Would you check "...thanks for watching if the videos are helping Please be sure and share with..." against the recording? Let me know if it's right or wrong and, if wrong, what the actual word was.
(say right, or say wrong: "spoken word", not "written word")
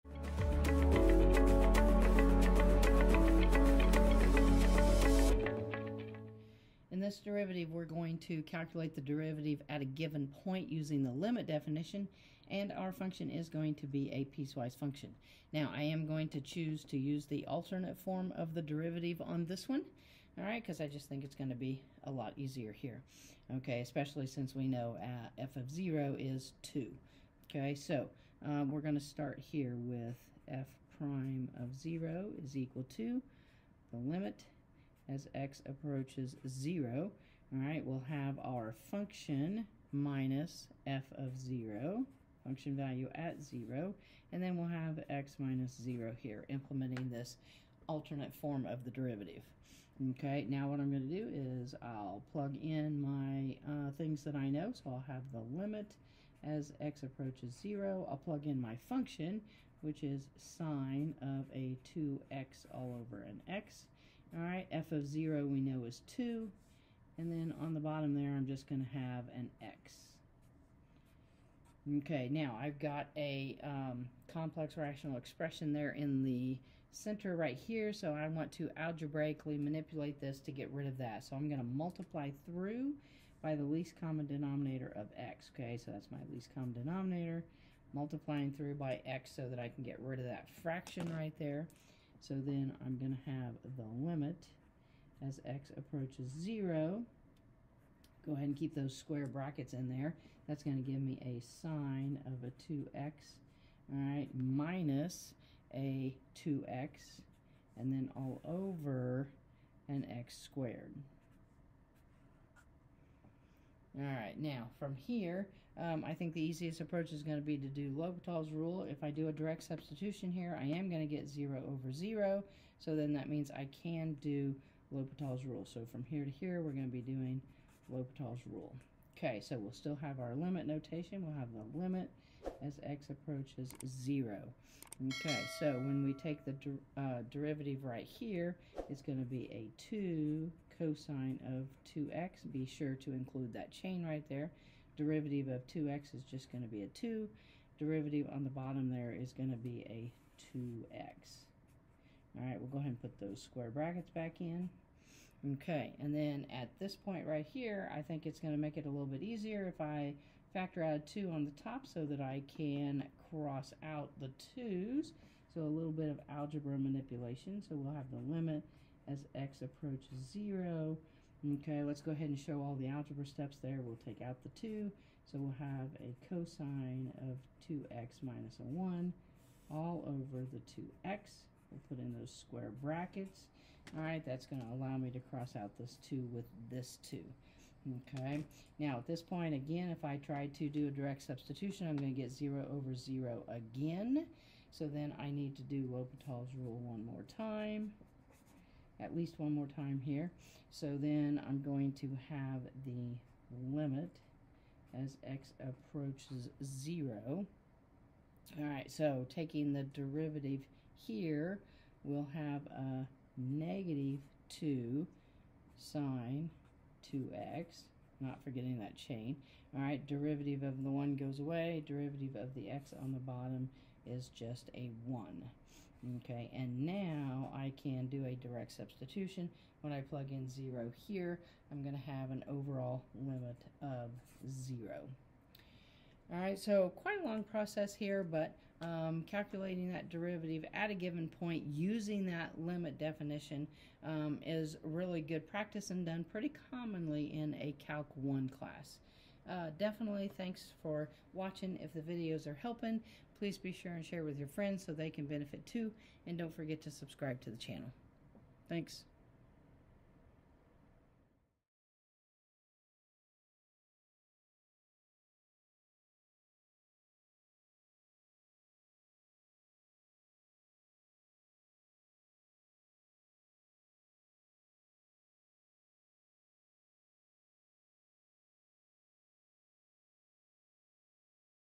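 right.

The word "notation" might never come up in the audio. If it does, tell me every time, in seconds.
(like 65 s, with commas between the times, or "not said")
130 s.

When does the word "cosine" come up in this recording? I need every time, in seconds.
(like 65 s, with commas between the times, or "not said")
140 s, 176 s.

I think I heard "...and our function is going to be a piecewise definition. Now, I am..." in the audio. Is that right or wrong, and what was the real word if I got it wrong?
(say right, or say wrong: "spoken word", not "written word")
wrong: "function", not "definition".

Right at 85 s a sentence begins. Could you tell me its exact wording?
Okay, so that's my least common denominator, multiplying through by x so that I can get rid of that fraction right there.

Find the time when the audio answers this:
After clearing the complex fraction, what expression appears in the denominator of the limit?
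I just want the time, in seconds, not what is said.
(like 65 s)
110 s.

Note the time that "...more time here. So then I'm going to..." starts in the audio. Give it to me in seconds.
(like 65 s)
199 s.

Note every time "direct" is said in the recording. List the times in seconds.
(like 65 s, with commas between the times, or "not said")
119 s, 190 s, 228 s.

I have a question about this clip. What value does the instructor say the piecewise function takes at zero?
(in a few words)
2.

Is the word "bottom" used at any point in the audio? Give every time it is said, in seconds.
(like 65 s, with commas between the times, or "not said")
67 s, 148 s, 223 s.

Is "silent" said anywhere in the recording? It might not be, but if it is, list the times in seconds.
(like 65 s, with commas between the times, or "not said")
not said.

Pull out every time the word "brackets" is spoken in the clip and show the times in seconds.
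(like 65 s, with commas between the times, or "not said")
99 s, 153 s, 182 s.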